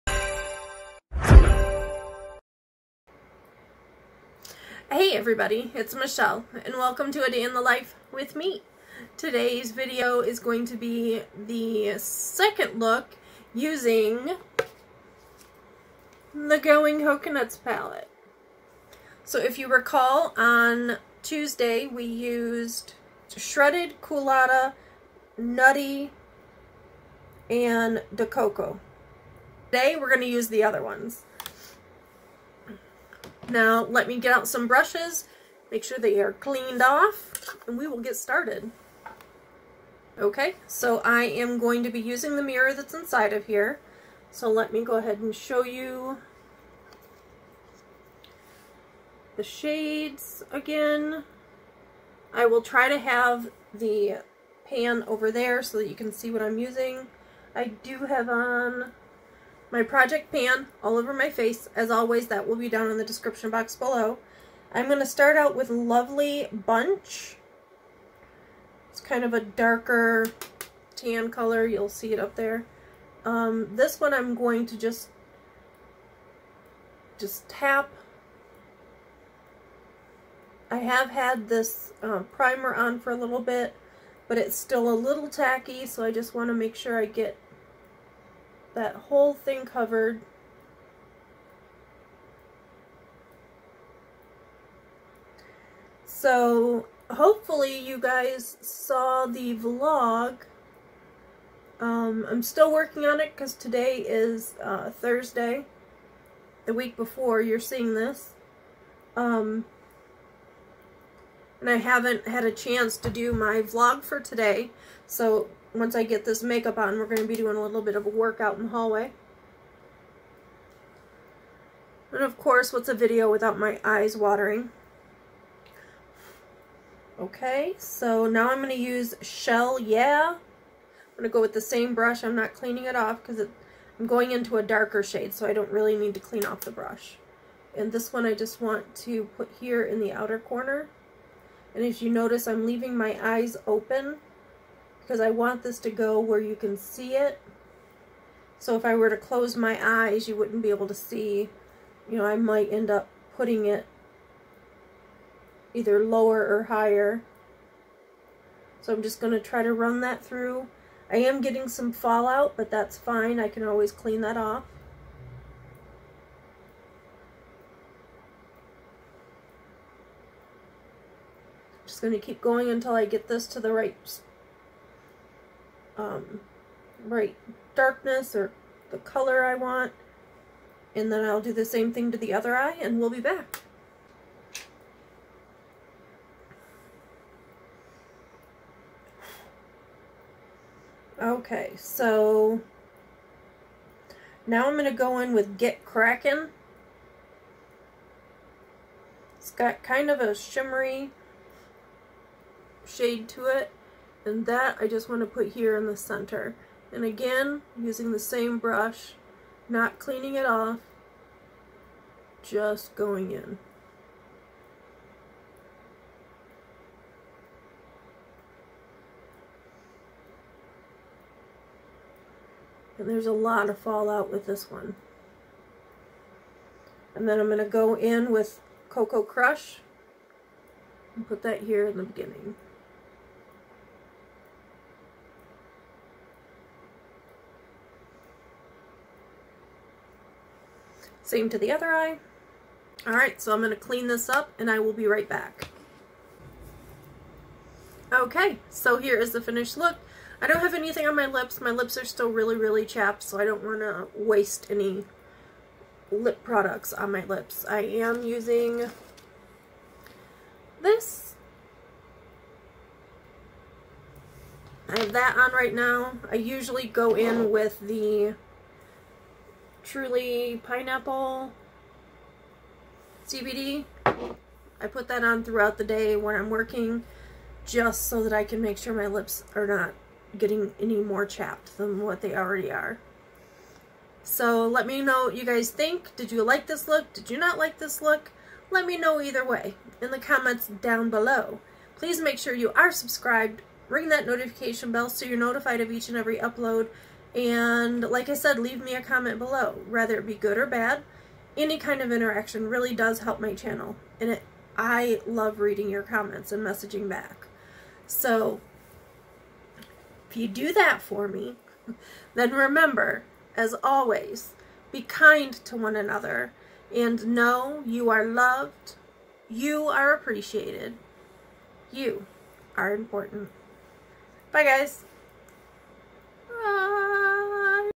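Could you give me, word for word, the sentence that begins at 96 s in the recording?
So hopefully you guys saw the vlog.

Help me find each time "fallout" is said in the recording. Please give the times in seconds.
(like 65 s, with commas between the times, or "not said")
161 s, 223 s.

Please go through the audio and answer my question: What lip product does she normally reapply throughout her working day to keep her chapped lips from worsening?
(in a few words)
Truly Pineapple CBD.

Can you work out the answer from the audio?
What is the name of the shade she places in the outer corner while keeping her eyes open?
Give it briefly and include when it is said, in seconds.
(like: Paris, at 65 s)
Shell Yeah, at 129 s.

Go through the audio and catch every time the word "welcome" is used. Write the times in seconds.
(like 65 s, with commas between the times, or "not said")
6 s.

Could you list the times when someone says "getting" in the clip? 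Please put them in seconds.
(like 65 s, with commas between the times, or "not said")
161 s, 280 s.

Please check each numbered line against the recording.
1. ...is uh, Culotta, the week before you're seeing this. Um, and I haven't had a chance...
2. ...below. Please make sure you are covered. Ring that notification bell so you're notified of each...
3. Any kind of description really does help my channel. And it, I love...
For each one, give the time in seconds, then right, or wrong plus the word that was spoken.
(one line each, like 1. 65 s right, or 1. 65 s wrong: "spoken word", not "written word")
1. 104 s wrong: "Thursday", not "Culotta"
2. 291 s wrong: "subscribed", not "covered"
3. 301 s wrong: "interaction", not "description".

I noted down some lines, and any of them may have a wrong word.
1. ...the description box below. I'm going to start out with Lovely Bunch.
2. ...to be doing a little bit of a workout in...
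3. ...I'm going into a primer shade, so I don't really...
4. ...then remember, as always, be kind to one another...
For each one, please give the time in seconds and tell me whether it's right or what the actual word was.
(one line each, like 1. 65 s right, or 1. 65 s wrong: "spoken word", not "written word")
1. 62 s right
2. 117 s right
3. 133 s wrong: "darker", not "primer"
4. 312 s right.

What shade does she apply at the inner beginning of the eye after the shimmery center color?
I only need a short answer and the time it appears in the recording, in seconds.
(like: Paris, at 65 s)
Cocoa Crush, at 228 s.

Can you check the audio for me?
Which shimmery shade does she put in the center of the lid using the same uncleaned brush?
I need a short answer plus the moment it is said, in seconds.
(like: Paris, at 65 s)
Get Kraken, at 195 s.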